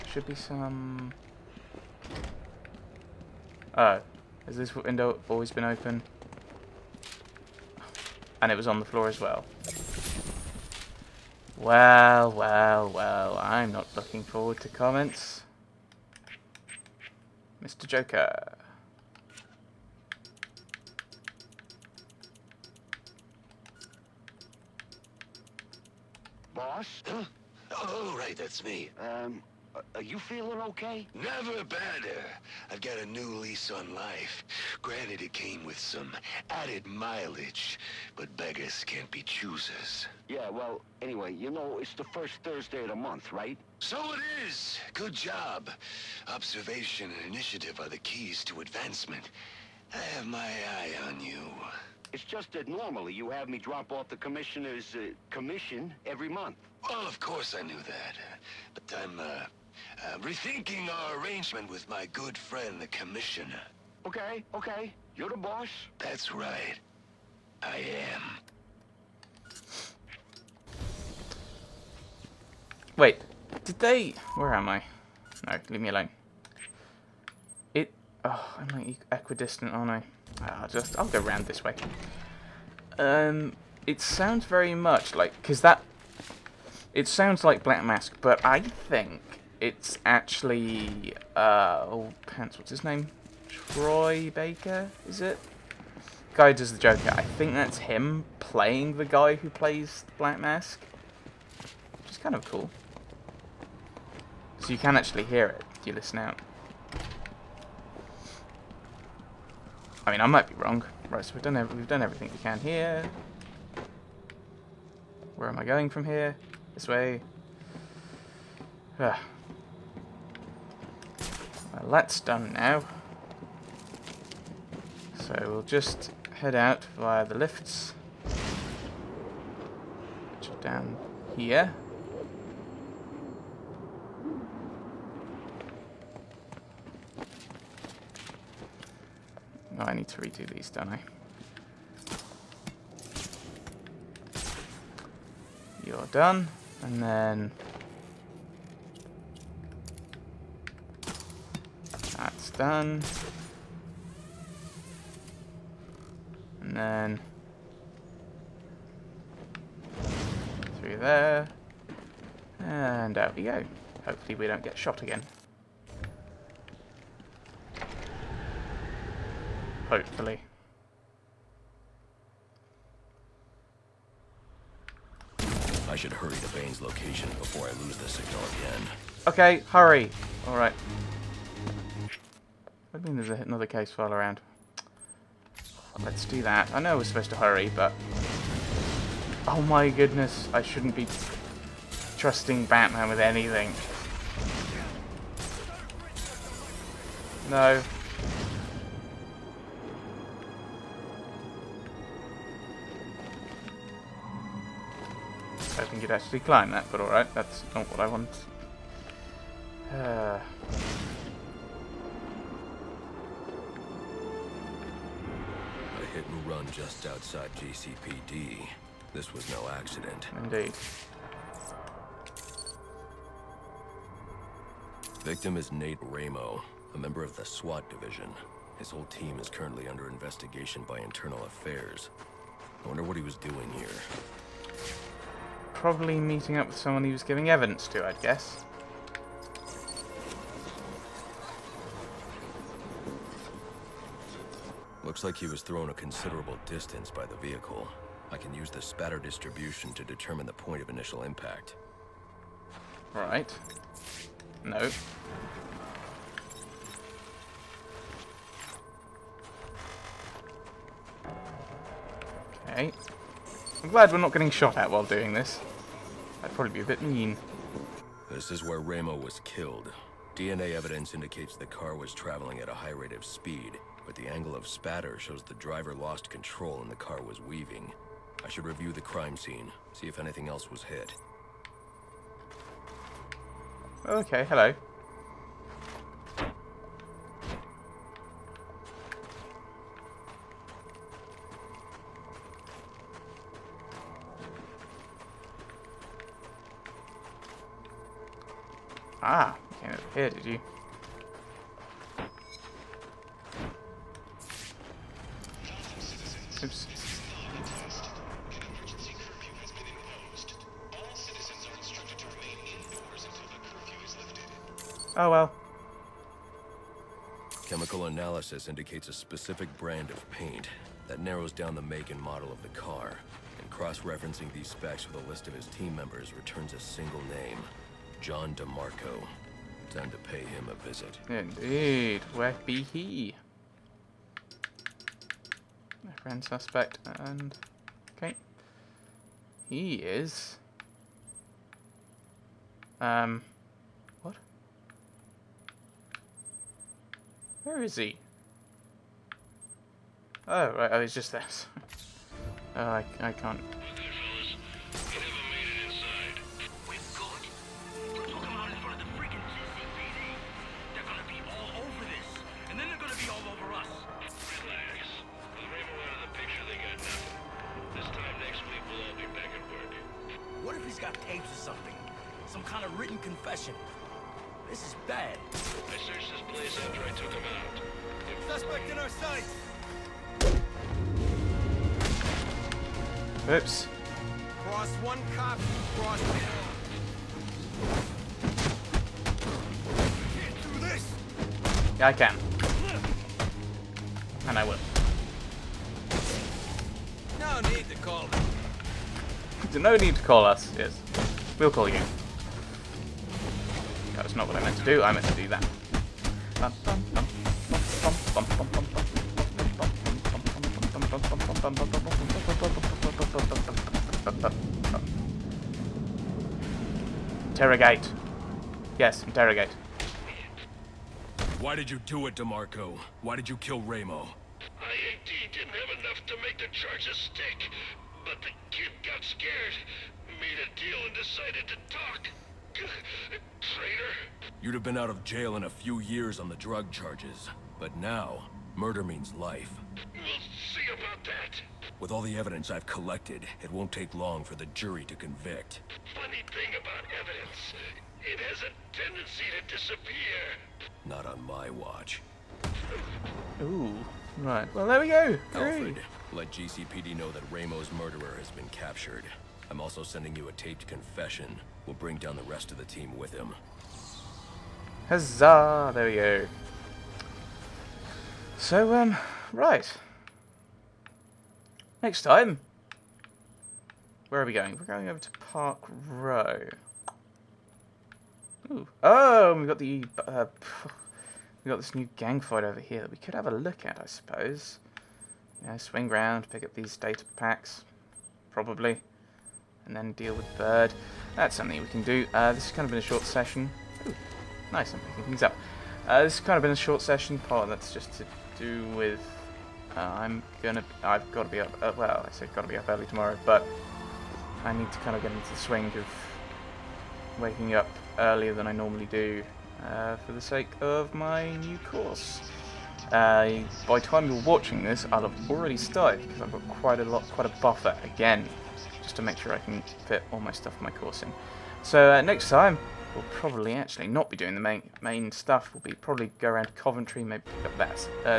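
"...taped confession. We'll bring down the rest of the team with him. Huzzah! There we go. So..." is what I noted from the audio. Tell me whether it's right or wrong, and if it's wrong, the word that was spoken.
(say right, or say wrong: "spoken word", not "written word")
right.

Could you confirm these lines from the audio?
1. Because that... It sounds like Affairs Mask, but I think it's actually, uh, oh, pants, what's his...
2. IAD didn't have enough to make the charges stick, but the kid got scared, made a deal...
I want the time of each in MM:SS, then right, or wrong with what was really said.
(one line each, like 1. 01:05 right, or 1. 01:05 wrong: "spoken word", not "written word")
1. 01:25 wrong: "Black", not "Affairs"
2. 07:04 right.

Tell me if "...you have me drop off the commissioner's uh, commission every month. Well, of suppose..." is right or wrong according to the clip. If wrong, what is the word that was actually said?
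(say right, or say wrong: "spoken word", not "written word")
wrong: "course", not "suppose".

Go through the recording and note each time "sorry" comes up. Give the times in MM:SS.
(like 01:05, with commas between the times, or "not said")
not said.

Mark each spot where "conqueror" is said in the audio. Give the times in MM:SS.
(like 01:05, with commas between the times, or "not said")
not said.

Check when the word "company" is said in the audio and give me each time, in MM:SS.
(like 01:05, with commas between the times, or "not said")
not said.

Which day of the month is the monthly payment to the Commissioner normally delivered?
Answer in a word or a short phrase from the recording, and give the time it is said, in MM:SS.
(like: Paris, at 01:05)
First Thursday, at 00:42.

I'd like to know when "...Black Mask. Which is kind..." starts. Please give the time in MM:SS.
01:40.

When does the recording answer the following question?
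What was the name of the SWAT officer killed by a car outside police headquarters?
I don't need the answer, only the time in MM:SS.
03:45.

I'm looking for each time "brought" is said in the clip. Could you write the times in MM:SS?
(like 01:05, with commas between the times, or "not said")
not said.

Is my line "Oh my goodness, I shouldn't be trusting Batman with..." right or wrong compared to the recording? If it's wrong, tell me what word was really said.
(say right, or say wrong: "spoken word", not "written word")
right.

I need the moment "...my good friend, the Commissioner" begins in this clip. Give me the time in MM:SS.
01:01.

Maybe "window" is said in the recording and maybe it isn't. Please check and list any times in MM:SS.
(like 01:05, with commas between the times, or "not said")
00:04.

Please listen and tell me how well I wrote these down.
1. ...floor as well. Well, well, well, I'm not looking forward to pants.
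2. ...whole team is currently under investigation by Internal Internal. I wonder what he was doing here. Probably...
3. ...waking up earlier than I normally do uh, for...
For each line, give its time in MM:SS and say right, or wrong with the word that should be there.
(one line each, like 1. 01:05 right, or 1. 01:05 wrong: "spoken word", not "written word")
1. 00:08 wrong: "comments", not "pants"
2. 03:48 wrong: "Affairs", not "Internal"
3. 08:27 right.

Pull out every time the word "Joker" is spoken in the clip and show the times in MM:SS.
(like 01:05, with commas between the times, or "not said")
00:17, 01:36.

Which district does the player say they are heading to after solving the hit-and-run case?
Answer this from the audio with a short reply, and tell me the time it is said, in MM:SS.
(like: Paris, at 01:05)
Park Row, at 07:55.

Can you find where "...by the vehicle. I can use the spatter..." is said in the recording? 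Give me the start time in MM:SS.
04:07.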